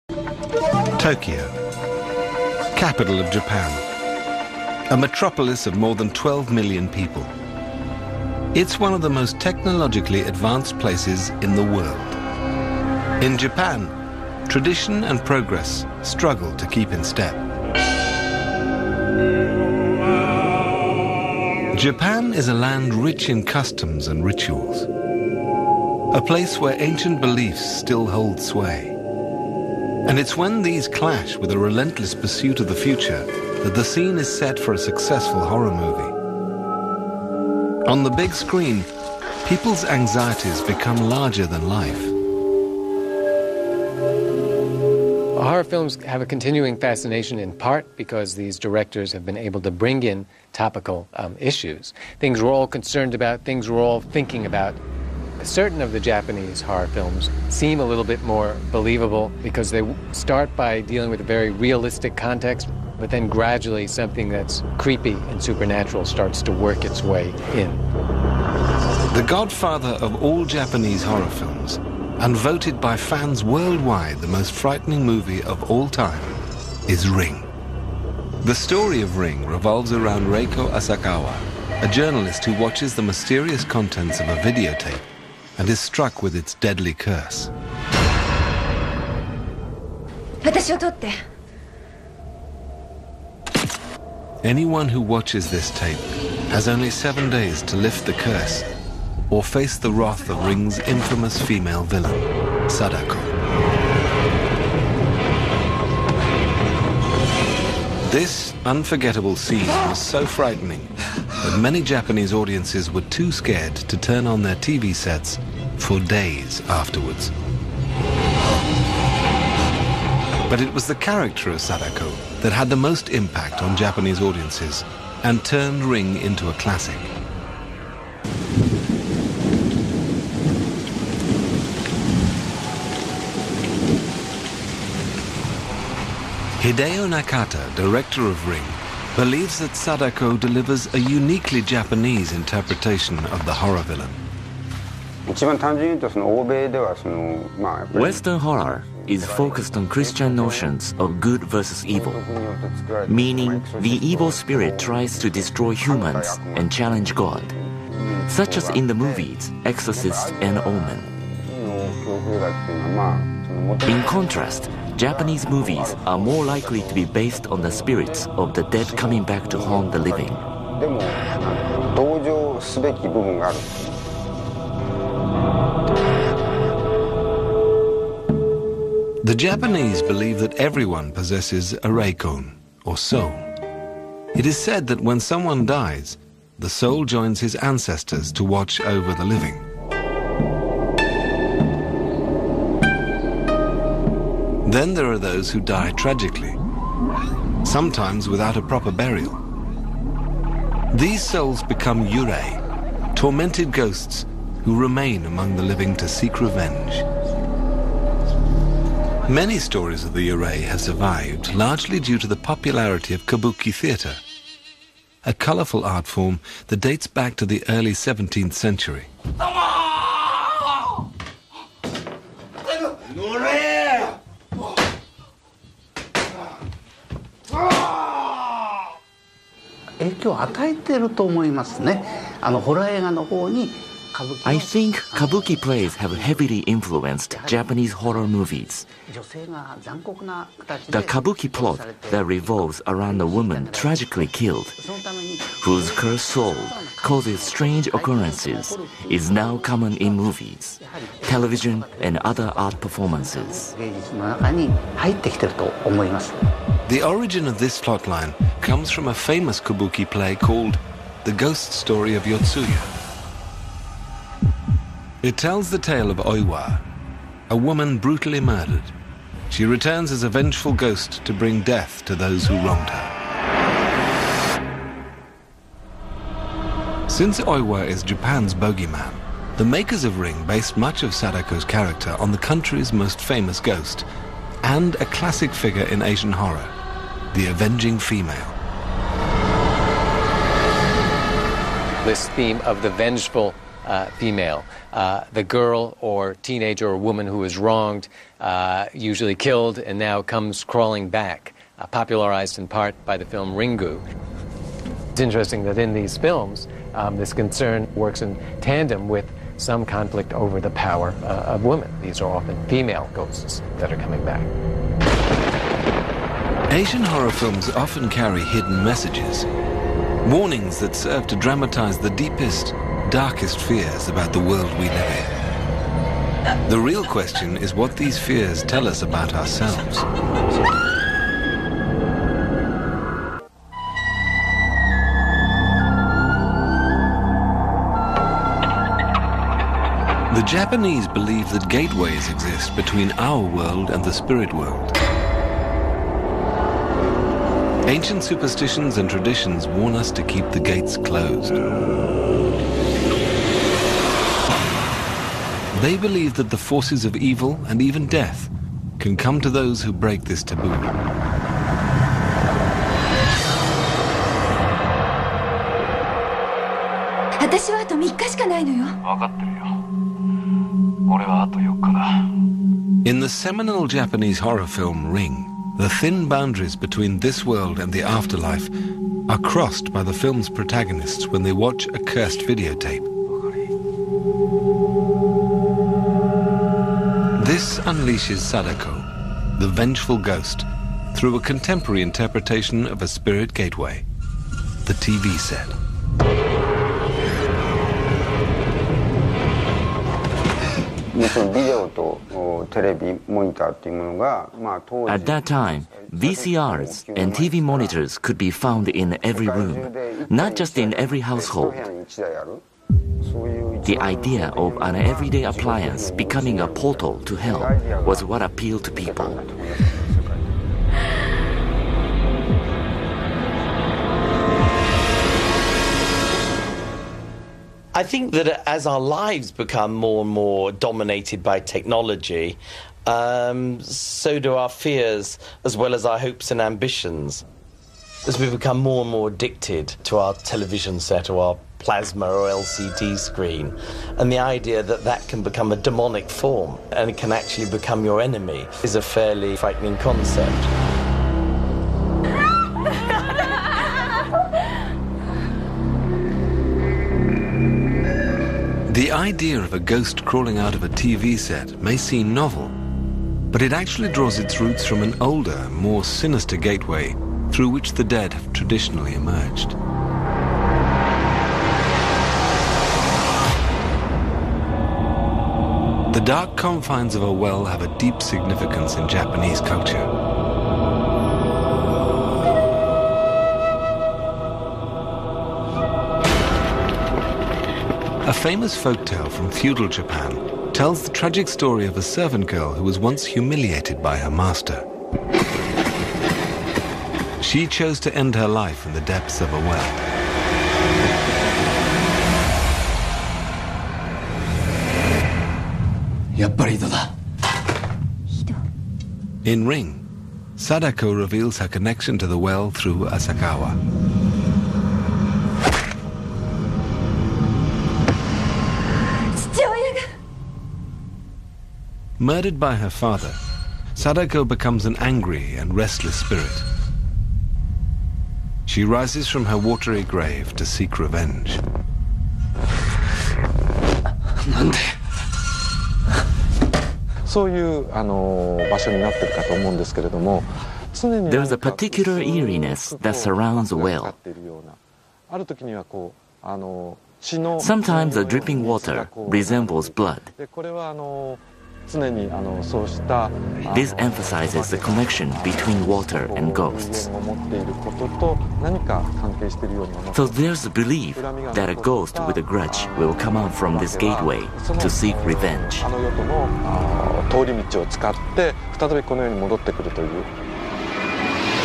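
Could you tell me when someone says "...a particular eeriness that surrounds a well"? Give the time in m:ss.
9:01.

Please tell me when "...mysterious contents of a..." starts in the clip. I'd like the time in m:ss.
1:23.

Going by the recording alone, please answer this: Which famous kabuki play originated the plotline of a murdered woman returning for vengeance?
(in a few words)
The Ghost Story of Yotsuya.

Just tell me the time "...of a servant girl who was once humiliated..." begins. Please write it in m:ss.
8:11.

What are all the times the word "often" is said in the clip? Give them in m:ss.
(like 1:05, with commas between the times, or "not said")
5:12, 5:17.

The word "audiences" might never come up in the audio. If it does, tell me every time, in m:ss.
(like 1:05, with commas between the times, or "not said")
1:52, 2:04.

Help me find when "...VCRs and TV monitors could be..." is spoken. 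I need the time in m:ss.
6:46.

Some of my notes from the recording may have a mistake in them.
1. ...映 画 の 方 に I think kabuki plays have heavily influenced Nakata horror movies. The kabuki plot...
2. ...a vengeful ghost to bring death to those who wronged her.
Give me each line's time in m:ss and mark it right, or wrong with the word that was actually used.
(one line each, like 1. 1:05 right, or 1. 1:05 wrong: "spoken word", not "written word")
1. 3:52 wrong: "Japanese", not "Nakata"
2. 4:30 right.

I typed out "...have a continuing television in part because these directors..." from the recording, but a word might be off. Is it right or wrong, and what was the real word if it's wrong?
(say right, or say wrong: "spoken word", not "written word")
wrong: "fascination", not "television".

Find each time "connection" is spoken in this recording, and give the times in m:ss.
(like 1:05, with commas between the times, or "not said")
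8:31, 9:14.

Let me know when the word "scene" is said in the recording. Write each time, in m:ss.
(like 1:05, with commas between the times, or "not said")
0:33, 1:49.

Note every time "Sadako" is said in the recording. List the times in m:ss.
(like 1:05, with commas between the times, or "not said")
1:42, 2:01, 2:19, 4:41, 6:28, 8:30, 8:43.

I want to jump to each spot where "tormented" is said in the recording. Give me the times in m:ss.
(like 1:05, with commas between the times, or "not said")
3:23.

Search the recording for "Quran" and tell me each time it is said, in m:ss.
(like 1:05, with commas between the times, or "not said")
not said.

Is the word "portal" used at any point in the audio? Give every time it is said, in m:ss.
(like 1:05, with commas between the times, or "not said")
6:56.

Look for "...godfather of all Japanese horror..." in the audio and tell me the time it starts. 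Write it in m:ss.
1:09.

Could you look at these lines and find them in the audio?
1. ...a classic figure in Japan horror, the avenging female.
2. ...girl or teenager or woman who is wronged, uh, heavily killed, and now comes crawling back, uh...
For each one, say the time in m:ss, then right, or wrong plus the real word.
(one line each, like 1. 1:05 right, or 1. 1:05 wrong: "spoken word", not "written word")
1. 4:44 wrong: "Asian", not "Japan"
2. 4:55 wrong: "usually", not "heavily".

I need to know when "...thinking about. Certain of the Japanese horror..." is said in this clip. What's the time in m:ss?
0:54.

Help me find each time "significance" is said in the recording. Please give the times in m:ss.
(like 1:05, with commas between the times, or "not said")
7:58.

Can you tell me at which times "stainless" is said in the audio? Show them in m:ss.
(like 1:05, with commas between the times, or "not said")
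not said.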